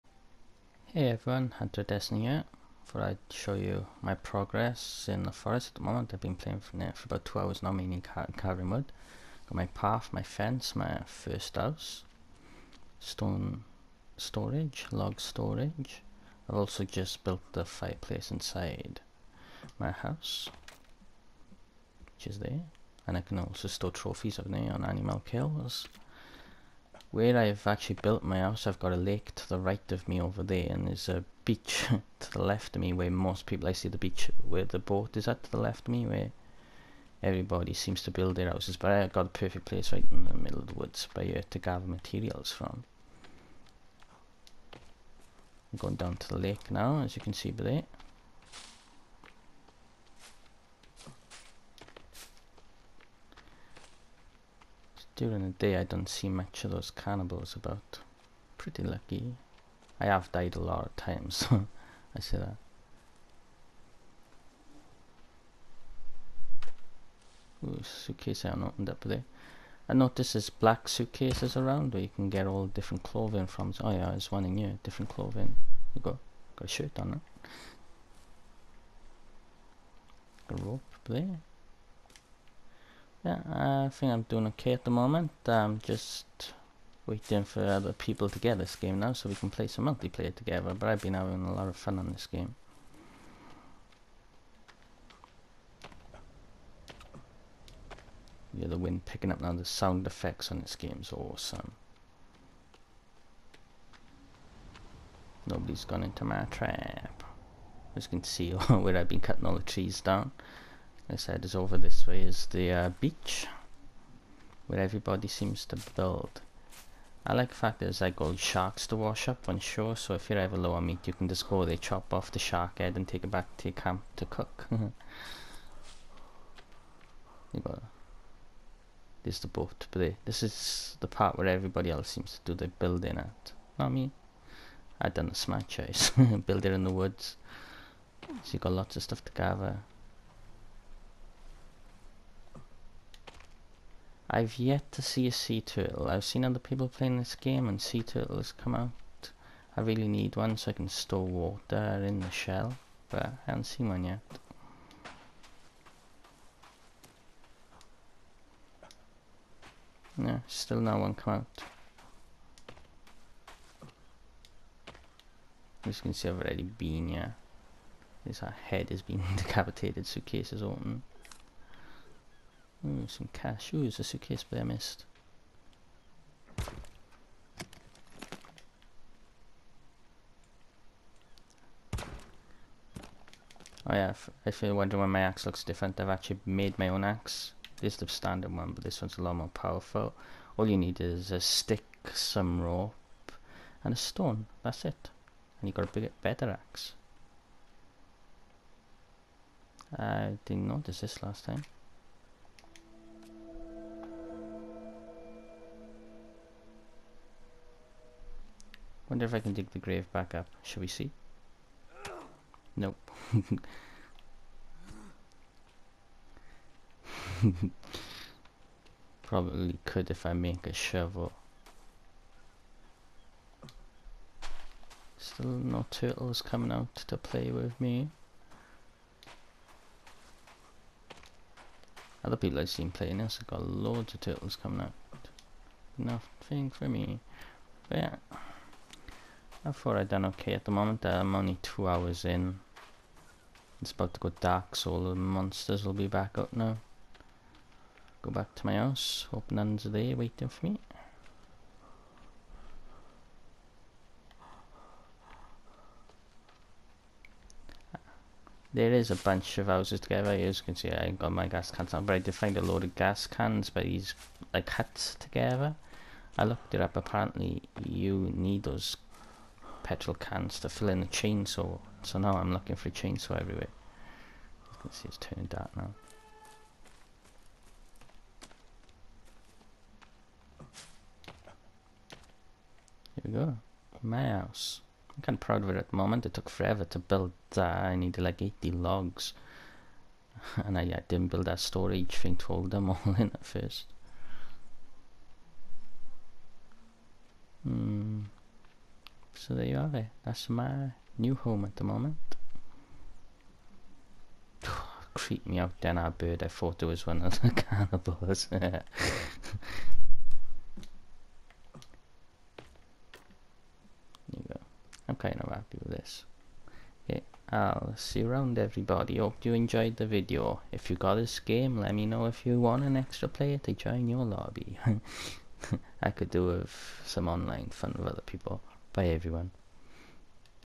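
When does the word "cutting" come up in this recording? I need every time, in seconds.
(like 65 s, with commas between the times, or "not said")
109 s.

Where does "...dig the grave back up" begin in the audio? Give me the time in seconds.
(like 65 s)
209 s.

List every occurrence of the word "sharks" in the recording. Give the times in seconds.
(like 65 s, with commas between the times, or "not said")
118 s, 122 s.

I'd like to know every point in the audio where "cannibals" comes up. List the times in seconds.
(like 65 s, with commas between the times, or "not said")
56 s, 307 s.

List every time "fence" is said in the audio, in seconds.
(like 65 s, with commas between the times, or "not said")
10 s.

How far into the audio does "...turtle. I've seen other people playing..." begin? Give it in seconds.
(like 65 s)
145 s.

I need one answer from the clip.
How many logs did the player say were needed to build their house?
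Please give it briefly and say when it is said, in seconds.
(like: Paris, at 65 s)
80, at 288 s.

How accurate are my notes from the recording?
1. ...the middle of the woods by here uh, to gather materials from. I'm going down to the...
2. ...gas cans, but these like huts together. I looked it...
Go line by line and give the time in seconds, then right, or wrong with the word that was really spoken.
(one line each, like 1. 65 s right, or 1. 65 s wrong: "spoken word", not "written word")
1. 40 s right
2. 262 s right.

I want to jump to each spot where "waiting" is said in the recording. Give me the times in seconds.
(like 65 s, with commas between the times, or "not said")
87 s, 250 s.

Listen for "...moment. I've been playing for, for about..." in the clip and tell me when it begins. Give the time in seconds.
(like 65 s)
5 s.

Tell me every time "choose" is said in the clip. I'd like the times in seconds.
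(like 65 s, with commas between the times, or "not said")
not said.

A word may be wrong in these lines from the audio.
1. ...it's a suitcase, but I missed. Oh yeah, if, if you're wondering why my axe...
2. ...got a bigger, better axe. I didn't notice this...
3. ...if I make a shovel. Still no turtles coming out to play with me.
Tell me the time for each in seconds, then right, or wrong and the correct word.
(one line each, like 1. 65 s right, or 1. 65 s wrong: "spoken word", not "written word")
1. 173 s right
2. 195 s right
3. 220 s right.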